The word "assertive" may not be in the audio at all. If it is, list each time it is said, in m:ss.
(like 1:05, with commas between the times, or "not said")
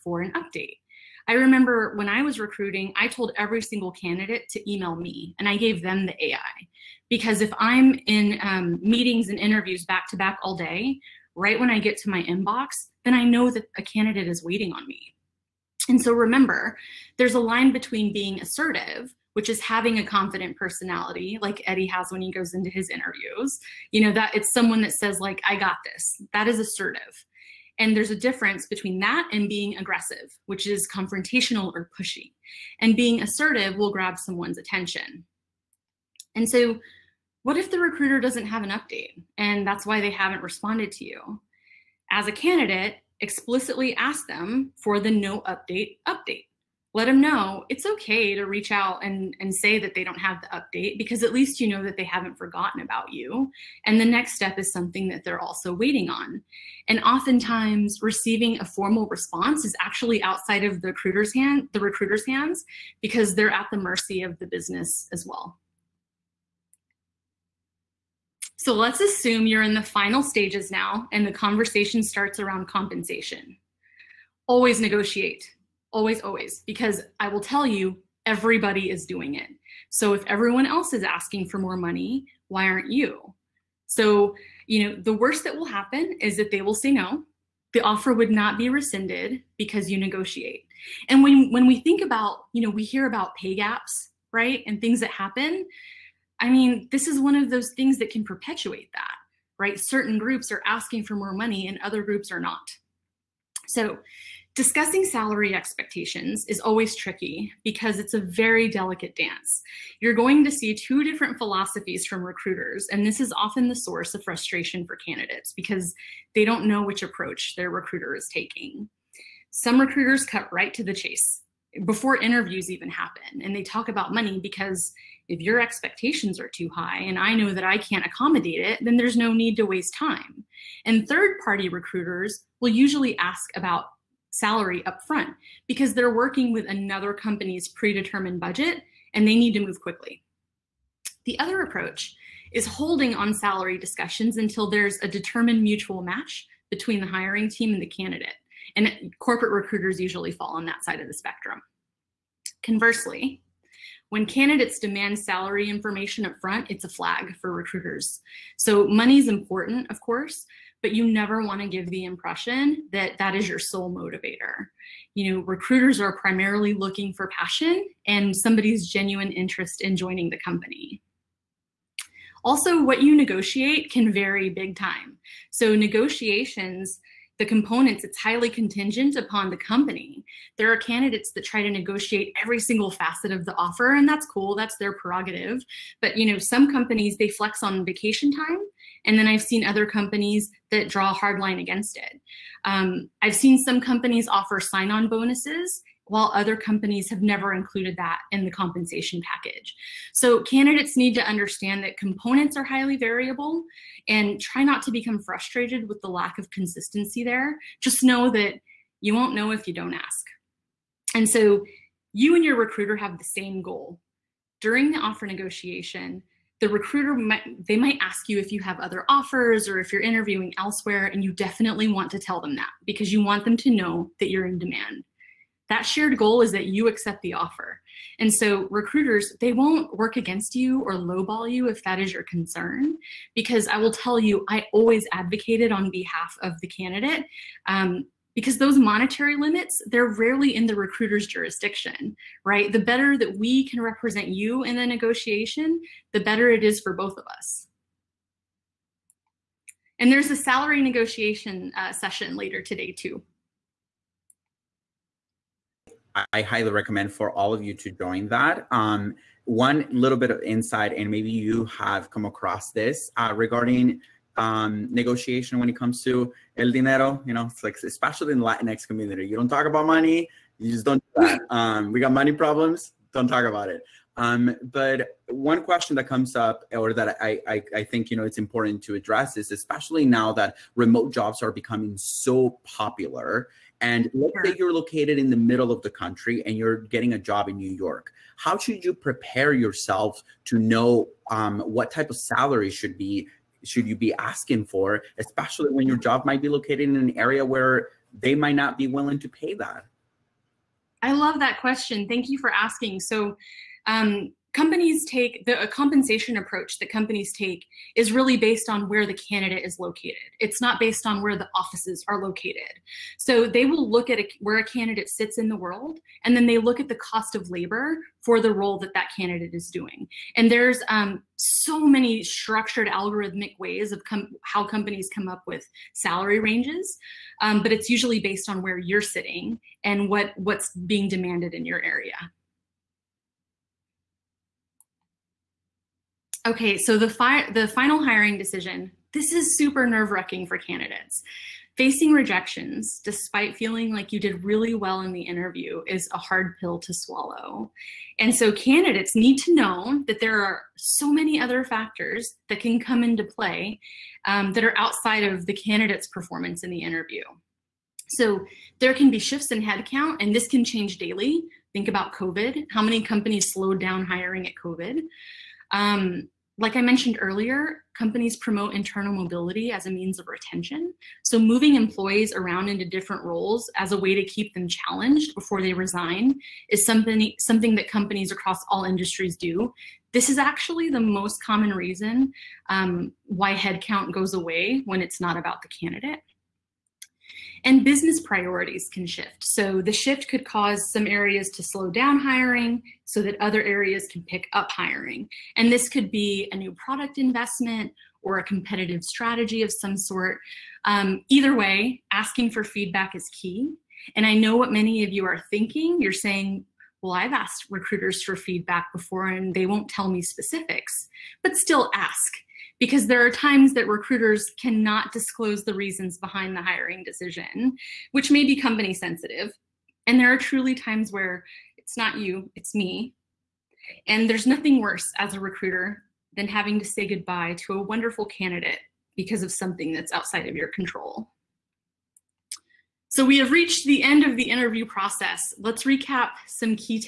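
0:18, 0:26, 0:33.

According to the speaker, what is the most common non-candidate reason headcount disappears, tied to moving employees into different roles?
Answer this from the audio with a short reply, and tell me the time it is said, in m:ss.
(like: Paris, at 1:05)
internal mobility, at 6:08.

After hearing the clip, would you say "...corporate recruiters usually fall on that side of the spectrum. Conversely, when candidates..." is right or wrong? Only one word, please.
right.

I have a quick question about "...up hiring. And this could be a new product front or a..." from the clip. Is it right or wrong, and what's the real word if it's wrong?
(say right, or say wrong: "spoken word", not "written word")
wrong: "investment", not "front".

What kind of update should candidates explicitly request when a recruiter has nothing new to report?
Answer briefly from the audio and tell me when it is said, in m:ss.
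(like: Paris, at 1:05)
no update update, at 0:45.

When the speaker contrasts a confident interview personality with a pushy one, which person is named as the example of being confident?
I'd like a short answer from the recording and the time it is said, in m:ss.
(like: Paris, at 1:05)
Eddie, at 0:21.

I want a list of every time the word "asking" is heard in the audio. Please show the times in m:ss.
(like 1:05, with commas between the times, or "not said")
1:21, 1:40, 4:54, 5:02, 6:42.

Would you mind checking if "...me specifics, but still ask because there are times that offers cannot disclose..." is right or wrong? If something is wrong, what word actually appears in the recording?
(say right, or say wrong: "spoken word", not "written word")
wrong: "recruiters", not "offers".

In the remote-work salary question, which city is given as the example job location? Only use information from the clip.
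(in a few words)
New York.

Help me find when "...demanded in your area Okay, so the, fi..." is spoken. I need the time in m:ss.
5:31.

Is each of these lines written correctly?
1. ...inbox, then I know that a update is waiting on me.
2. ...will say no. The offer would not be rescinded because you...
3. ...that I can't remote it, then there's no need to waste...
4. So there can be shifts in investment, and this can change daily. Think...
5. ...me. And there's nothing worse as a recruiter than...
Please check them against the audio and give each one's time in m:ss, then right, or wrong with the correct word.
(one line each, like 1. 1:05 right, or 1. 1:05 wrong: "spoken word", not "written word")
1. 0:12 wrong: "candidate", not "update"
2. 1:26 right
3. 2:07 wrong: "accommodate", not "remote"
4. 5:58 wrong: "headcount", not "investment"
5. 7:02 right.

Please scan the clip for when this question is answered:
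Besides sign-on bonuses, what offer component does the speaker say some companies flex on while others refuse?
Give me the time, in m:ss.
3:07.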